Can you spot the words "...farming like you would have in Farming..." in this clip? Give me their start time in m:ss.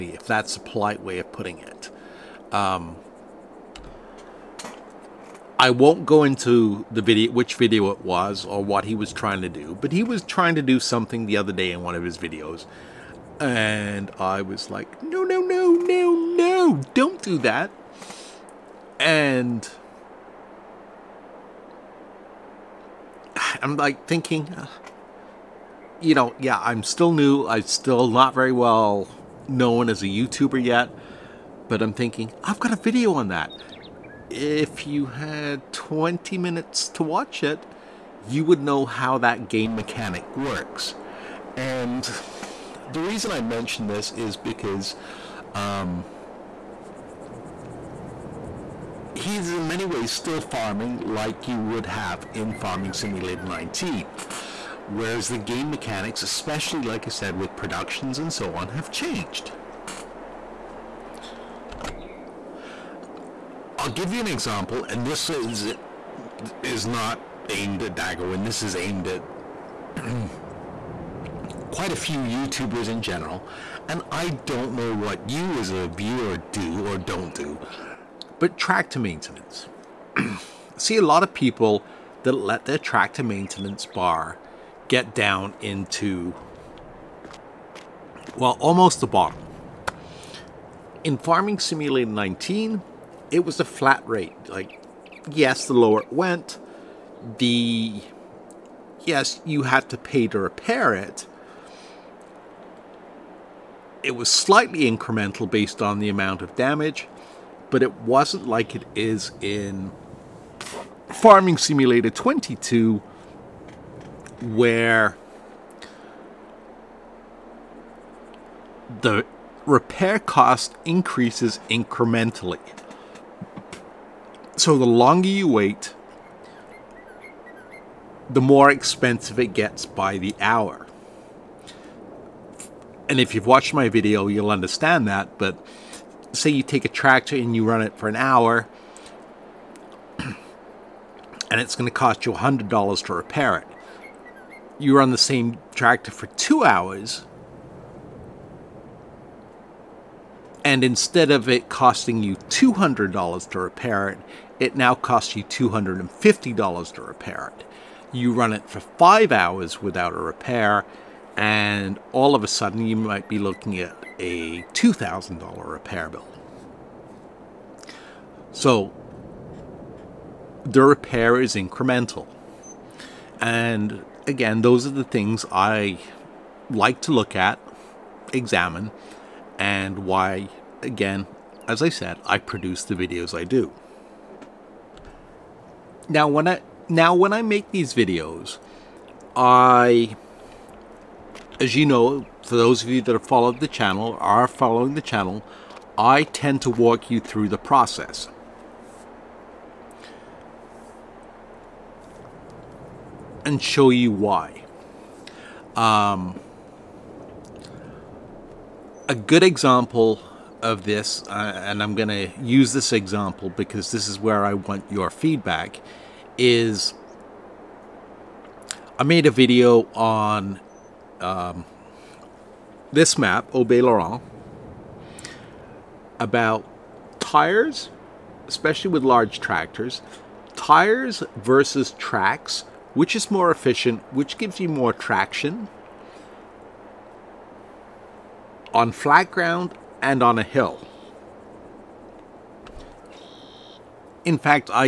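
0:50.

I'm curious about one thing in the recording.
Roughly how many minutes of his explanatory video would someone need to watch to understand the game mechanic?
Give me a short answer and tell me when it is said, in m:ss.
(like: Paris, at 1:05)
20, at 0:35.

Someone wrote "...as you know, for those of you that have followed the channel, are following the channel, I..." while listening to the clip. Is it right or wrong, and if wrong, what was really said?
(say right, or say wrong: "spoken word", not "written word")
right.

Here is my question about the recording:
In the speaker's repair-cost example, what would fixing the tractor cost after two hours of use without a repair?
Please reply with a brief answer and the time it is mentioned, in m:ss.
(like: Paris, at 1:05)
$250, at 2:35.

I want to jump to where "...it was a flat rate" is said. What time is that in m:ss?
1:33.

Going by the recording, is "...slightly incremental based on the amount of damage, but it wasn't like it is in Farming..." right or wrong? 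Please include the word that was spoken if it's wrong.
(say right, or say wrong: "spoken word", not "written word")
right.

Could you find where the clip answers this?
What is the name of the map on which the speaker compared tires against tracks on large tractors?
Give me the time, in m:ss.
3:43.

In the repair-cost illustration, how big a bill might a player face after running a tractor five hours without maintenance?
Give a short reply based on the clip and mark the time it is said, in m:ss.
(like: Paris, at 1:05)
$2,000, at 2:44.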